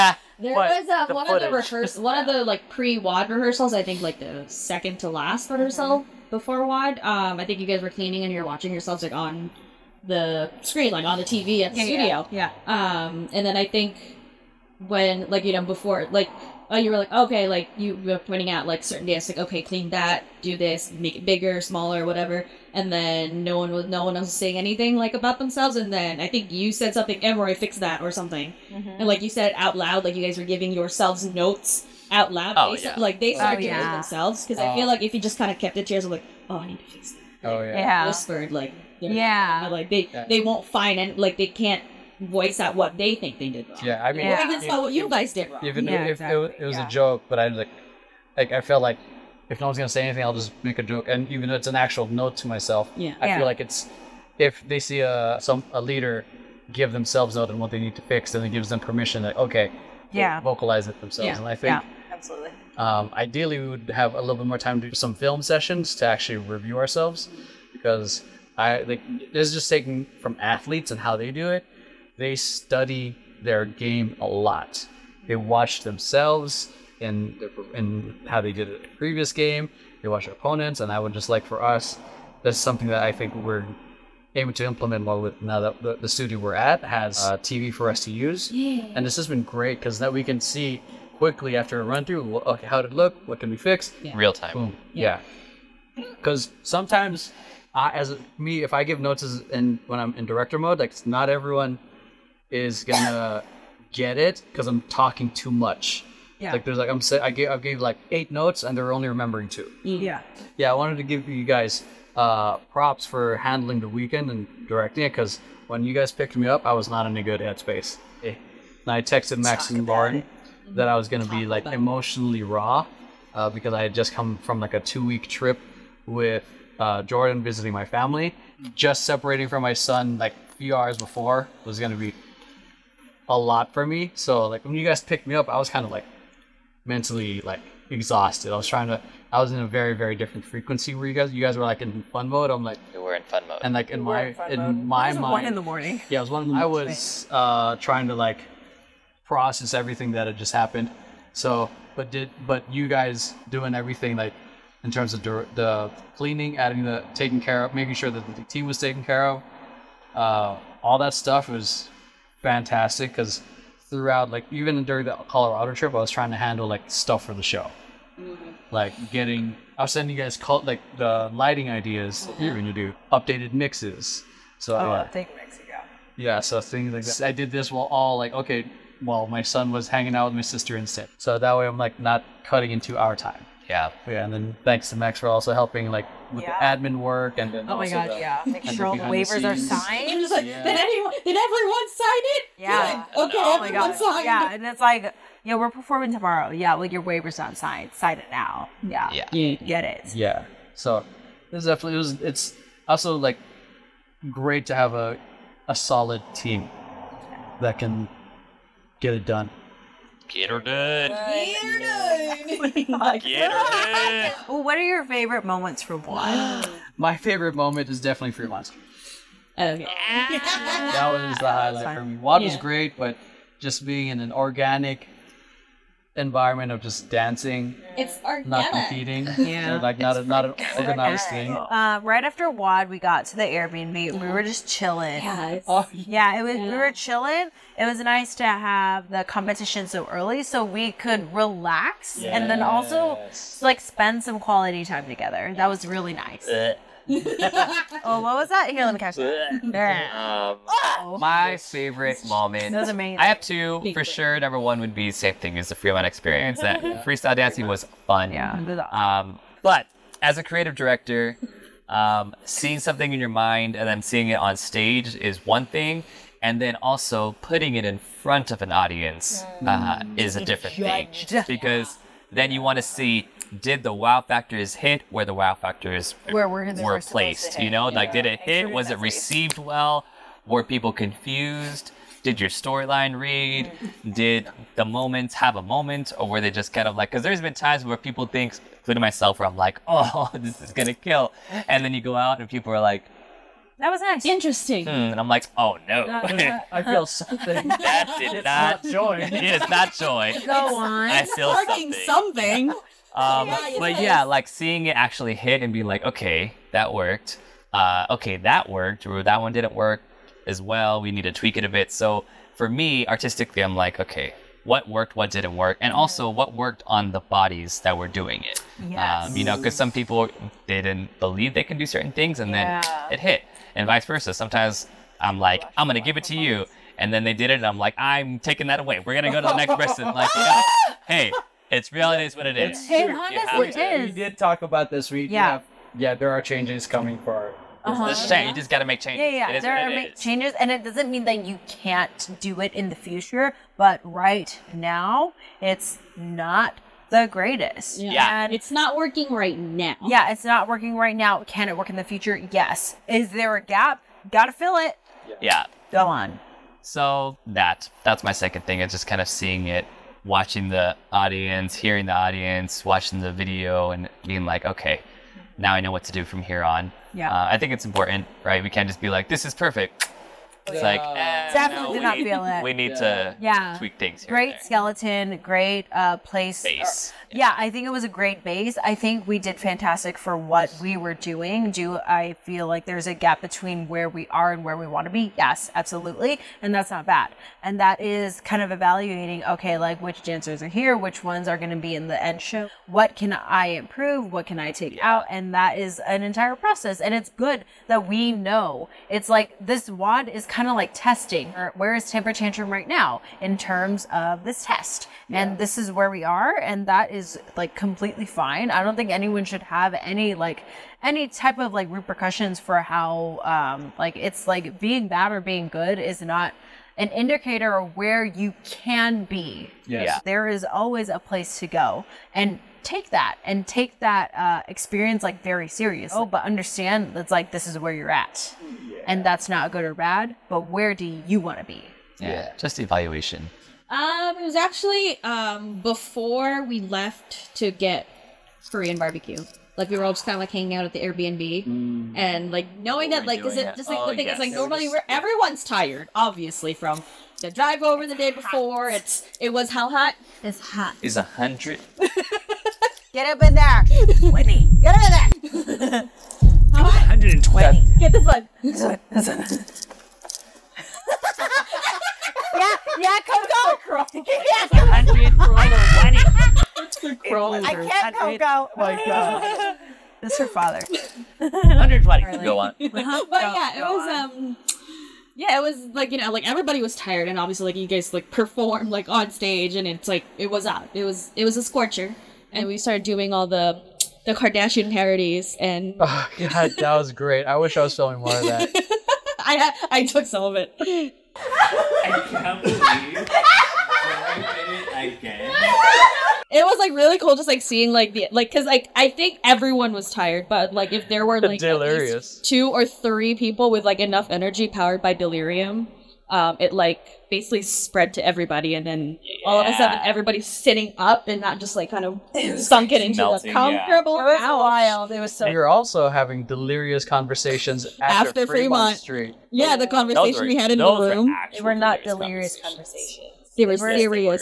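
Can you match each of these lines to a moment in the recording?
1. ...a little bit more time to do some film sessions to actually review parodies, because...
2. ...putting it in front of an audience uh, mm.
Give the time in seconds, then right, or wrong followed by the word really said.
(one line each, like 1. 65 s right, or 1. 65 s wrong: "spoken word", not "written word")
1. 64 s wrong: "ourselves", not "parodies"
2. 267 s right.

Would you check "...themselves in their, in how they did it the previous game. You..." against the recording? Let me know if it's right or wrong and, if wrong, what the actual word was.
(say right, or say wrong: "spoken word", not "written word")
right.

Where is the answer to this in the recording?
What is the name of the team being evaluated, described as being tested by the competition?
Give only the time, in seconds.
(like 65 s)
402 s.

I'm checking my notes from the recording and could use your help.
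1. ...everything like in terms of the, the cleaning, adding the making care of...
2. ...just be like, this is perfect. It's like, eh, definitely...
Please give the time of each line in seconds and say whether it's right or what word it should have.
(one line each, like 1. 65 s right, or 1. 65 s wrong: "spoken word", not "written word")
1. 153 s wrong: "taking", not "making"
2. 368 s right.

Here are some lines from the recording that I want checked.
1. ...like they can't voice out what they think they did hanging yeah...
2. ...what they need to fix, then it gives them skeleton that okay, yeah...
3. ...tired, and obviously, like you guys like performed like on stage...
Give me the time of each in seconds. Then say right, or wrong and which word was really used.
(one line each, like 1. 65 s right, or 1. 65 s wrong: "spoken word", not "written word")
1. 41 s wrong: "wrong", not "hanging"
2. 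57 s wrong: "permission", not "skeleton"
3. 476 s right.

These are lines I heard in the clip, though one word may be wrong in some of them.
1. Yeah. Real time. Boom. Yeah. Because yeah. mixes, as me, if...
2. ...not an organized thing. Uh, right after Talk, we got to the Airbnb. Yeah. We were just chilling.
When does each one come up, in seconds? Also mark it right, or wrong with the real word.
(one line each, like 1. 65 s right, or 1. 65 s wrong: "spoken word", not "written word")
1. 94 s wrong: "sometimes", not "mixes"
2. 230 s wrong: "WOD", not "Talk".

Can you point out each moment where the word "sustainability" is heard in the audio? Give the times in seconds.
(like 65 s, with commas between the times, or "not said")
not said.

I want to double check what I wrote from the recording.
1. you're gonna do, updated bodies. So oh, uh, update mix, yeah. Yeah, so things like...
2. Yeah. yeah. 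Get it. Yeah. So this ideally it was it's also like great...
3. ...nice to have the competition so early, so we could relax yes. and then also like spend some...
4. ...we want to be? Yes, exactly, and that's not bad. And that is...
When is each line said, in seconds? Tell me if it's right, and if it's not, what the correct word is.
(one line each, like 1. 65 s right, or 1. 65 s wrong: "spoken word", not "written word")
1. 172 s wrong: "mixes", not "bodies"
2. 199 s wrong: "definitely", not "ideally"
3. 237 s right
4. 384 s wrong: "absolutely", not "exactly".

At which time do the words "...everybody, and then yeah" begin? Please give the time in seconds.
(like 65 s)
508 s.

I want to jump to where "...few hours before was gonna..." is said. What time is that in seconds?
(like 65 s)
130 s.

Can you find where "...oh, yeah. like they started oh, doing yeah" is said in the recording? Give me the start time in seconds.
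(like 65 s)
32 s.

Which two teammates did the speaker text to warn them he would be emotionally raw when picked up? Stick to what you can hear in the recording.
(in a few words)
Max and Lauren.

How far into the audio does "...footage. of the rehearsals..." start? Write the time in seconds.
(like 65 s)
1 s.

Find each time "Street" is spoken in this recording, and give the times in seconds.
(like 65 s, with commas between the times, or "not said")
218 s, 518 s.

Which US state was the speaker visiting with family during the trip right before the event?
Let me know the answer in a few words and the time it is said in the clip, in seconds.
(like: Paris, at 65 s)
Colorado, at 165 s.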